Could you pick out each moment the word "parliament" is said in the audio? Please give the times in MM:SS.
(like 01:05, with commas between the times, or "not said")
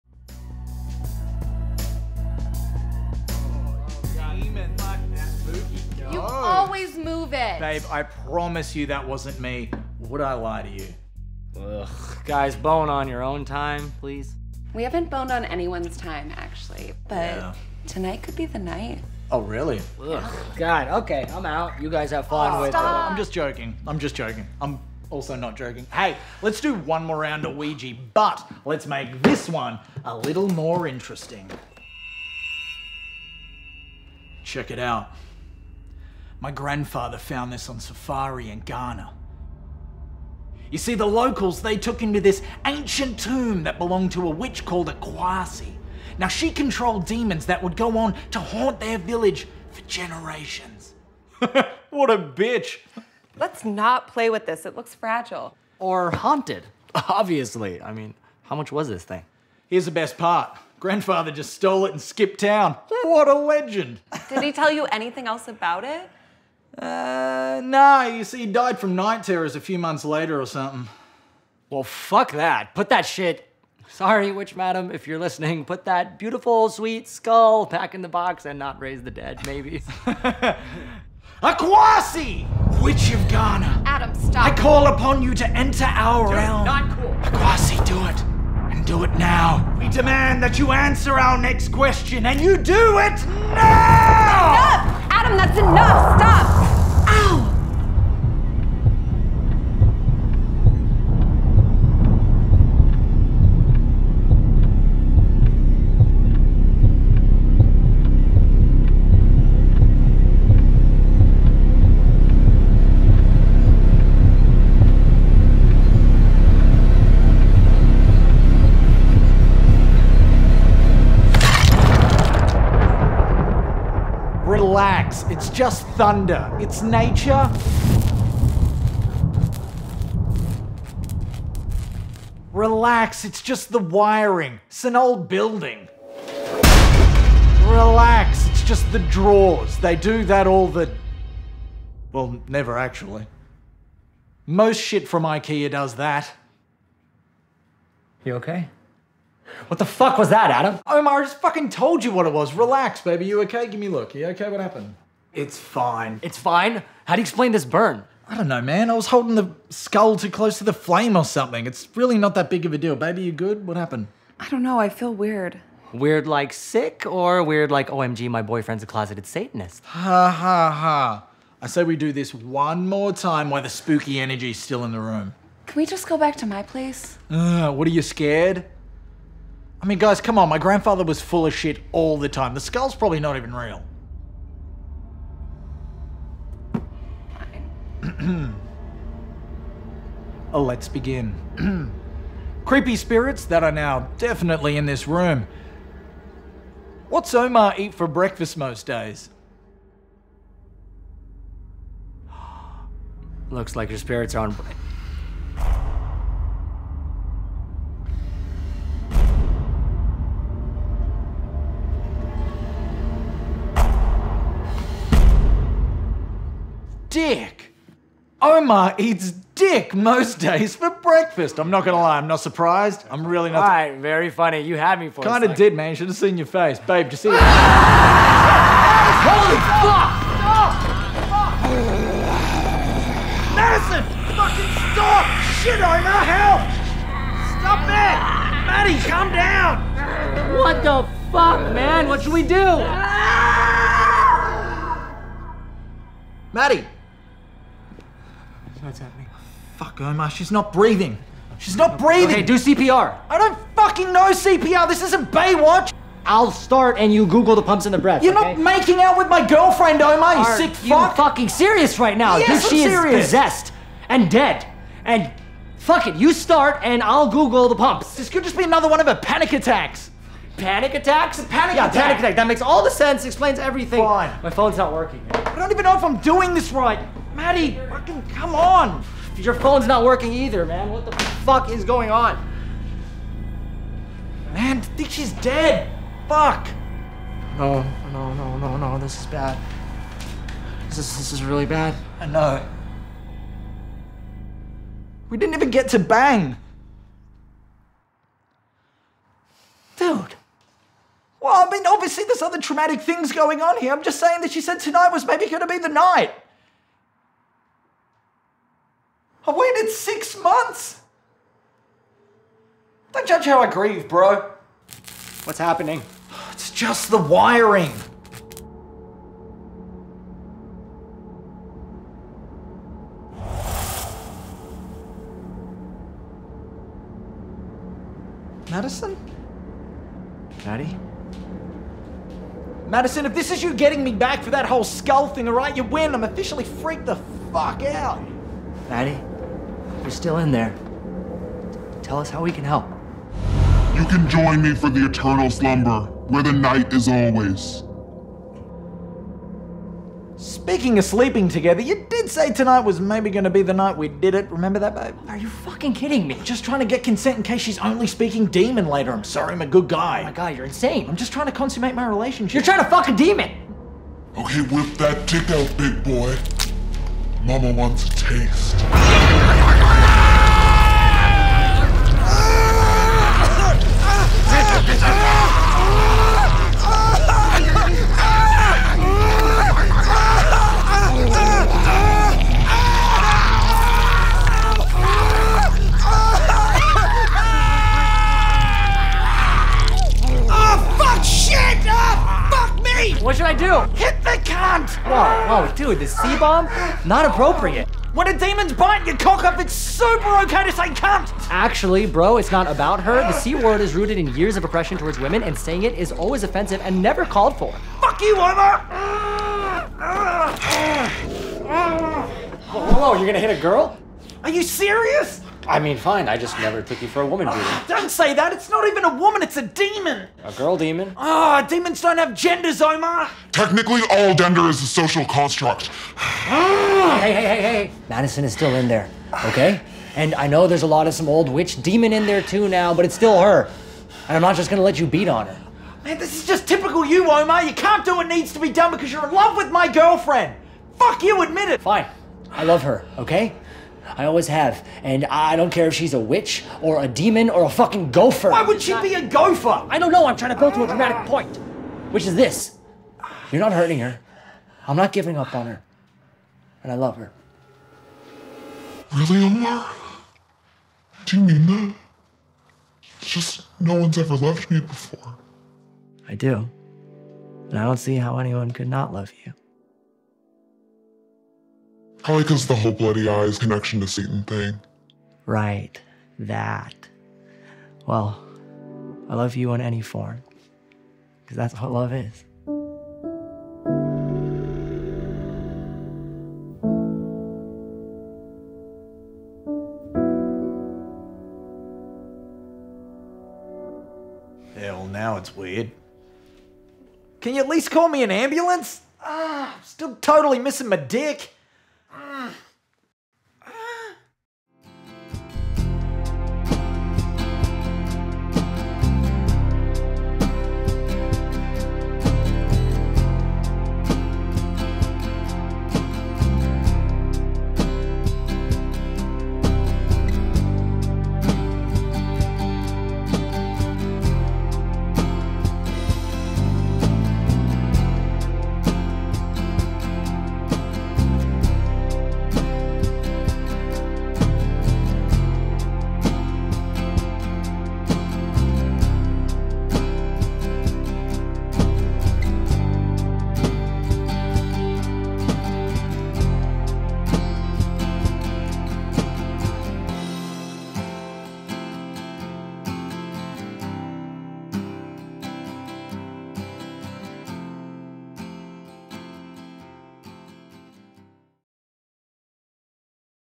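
not said.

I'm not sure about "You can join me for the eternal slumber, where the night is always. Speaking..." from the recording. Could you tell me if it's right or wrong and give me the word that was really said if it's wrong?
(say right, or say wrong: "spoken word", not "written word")
right.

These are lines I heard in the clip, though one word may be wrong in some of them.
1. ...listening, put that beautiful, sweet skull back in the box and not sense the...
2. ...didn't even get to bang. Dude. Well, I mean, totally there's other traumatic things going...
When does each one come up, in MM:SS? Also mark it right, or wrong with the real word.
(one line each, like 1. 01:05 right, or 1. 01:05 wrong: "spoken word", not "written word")
1. 01:15 wrong: "raise", not "sense"
2. 04:55 wrong: "obviously", not "totally".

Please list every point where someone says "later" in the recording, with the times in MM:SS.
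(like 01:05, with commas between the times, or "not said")
01:10, 05:58.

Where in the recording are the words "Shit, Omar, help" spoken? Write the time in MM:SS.
03:55.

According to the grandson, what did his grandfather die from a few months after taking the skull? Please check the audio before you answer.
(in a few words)
night terrors.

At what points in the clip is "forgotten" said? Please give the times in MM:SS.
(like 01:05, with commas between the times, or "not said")
not said.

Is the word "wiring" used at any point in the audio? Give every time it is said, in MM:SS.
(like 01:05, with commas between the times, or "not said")
02:13, 05:17.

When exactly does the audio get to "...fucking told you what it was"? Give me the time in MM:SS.
02:31.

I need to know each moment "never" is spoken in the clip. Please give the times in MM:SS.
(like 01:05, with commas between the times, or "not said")
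02:22, 06:47, 06:56.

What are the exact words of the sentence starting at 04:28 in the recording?
This could just be another one of her panic attacks.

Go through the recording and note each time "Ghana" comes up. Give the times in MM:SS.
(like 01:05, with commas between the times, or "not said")
00:38, 01:23.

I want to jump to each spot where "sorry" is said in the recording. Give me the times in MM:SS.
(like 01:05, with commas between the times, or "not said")
01:13, 05:59.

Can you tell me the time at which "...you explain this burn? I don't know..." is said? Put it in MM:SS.
02:37.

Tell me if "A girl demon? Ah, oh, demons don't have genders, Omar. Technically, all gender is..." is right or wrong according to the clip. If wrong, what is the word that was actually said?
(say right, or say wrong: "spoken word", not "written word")
right.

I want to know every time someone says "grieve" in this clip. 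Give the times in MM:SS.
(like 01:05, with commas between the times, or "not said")
05:13.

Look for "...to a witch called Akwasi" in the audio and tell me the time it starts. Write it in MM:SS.
00:44.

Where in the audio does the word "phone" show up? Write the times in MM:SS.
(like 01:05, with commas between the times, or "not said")
04:34, 04:39.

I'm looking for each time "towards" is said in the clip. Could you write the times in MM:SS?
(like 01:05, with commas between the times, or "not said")
06:44.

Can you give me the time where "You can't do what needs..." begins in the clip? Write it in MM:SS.
07:17.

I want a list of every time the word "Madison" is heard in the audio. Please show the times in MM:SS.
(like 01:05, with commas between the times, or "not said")
03:53, 05:28, 05:32, 07:08.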